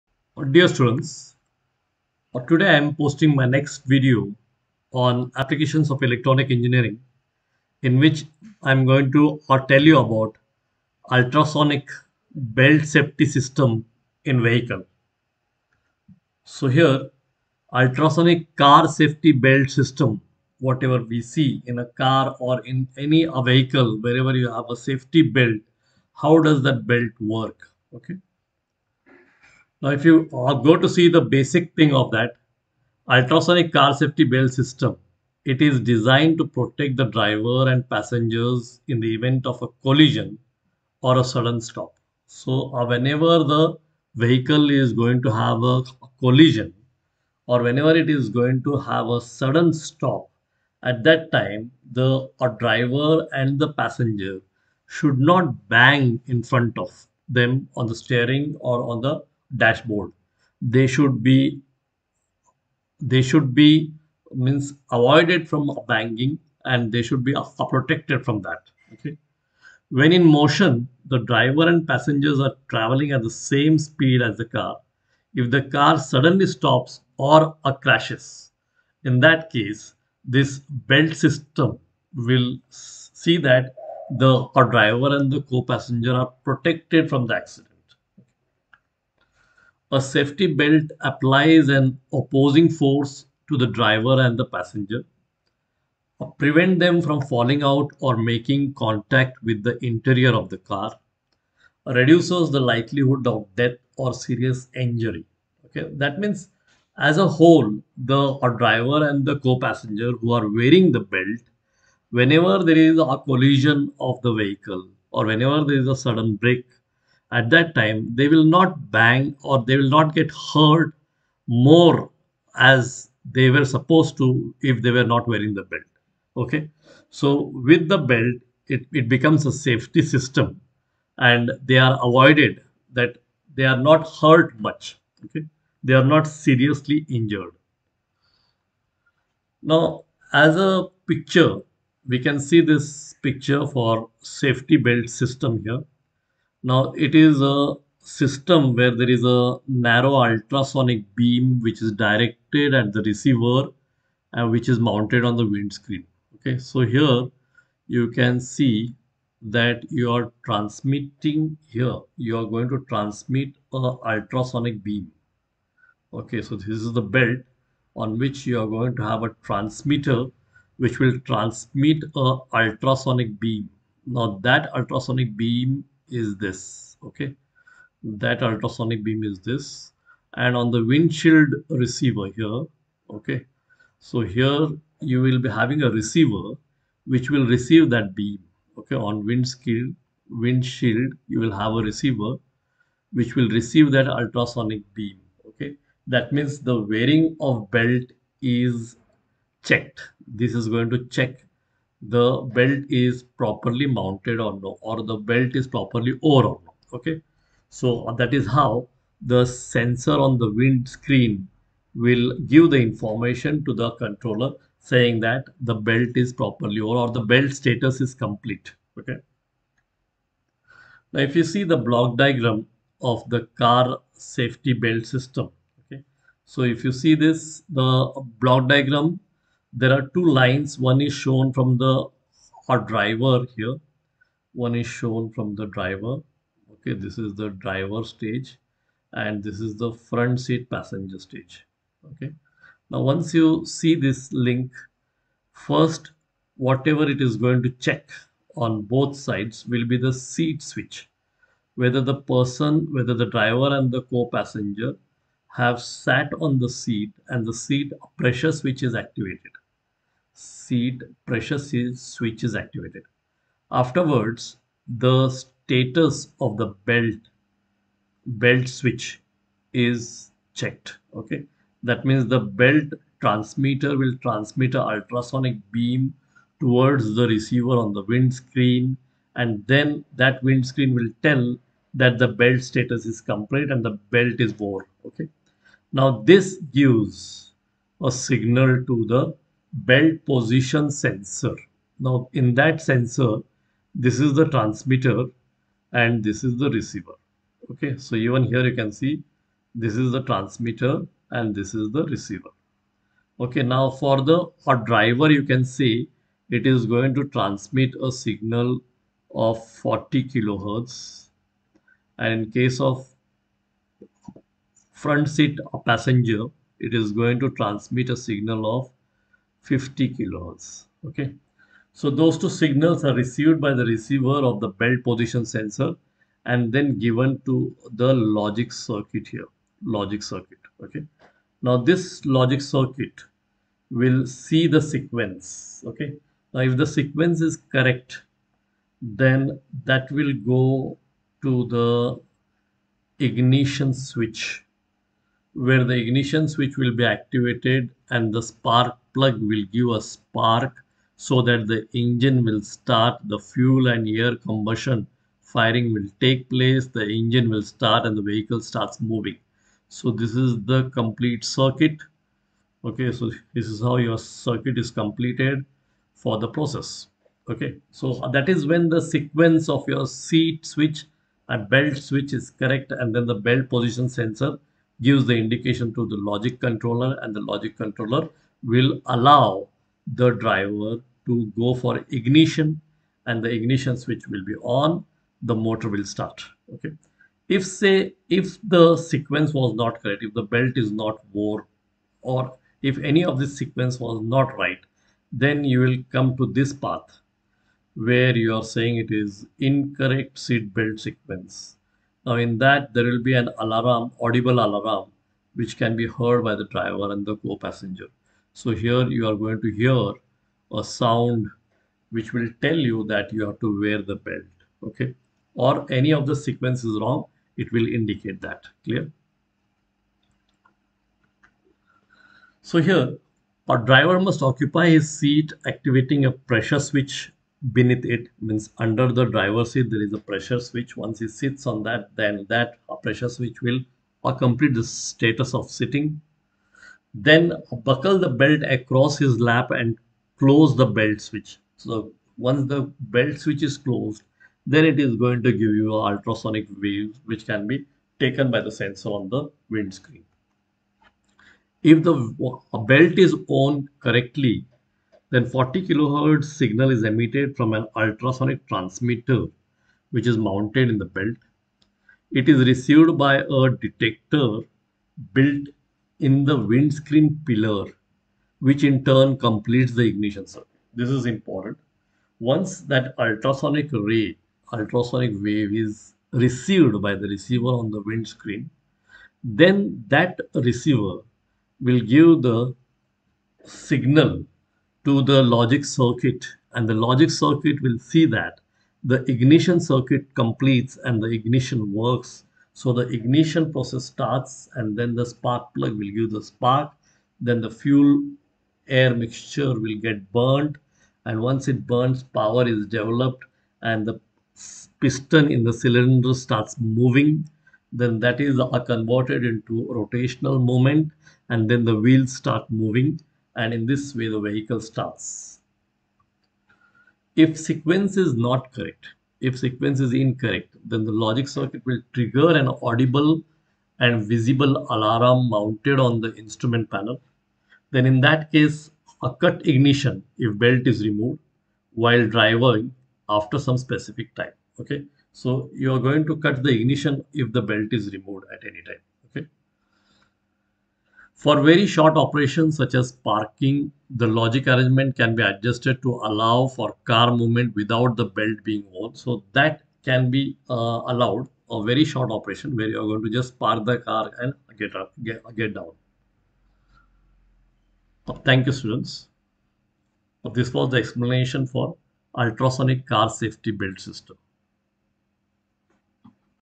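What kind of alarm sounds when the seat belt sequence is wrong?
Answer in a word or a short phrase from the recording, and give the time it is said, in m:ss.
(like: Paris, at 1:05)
audible alarm, at 6:44.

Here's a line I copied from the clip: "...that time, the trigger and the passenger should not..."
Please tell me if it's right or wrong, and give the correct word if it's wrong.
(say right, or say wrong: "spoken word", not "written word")
wrong: "driver", not "trigger".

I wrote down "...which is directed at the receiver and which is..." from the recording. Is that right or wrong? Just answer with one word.
right.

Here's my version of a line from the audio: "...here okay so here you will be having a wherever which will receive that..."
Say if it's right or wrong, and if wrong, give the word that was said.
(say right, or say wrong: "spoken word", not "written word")
wrong: "receiver", not "wherever".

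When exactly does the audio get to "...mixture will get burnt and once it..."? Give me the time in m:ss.
8:19.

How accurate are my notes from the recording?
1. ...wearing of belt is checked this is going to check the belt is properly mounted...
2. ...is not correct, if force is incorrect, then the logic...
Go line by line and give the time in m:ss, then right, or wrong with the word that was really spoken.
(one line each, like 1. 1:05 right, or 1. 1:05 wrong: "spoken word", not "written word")
1. 3:16 right
2. 8:38 wrong: "sequence", not "force".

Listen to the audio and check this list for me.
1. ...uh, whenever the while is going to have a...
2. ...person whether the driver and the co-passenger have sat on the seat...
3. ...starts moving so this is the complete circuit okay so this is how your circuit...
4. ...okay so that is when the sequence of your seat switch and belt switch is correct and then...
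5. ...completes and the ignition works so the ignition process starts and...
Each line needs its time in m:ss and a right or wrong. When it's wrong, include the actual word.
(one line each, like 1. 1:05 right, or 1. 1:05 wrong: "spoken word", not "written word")
1. 0:42 wrong: "vehicle", not "while"
2. 4:12 right
3. 5:58 right
4. 6:07 right
5. 8:10 right.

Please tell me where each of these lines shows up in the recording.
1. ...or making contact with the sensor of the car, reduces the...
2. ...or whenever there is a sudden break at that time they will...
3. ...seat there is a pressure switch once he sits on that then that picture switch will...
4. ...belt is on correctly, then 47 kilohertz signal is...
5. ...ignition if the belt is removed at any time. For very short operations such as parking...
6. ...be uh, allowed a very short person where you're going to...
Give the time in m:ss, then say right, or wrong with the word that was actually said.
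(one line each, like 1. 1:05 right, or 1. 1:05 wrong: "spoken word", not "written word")
1. 1:37 wrong: "interior", not "sensor"
2. 1:55 right
3. 7:09 wrong: "pressure", not "picture"
4. 7:32 wrong: "40", not "47"
5. 8:56 right
6. 9:10 wrong: "operation", not "person".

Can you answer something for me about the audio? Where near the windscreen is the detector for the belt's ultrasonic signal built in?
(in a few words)
windscreen pillar.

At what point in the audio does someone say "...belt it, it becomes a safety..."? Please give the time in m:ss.
2:07.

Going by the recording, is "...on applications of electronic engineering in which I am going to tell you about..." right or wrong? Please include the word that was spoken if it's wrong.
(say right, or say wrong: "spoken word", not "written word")
right.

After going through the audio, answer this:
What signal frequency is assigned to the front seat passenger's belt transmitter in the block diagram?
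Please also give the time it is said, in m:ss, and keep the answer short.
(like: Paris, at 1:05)
50 kHz, at 5:19.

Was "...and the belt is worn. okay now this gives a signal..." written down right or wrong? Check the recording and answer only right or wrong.
right.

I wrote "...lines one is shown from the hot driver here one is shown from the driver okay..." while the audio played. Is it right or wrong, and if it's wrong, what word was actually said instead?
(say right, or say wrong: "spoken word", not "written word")
right.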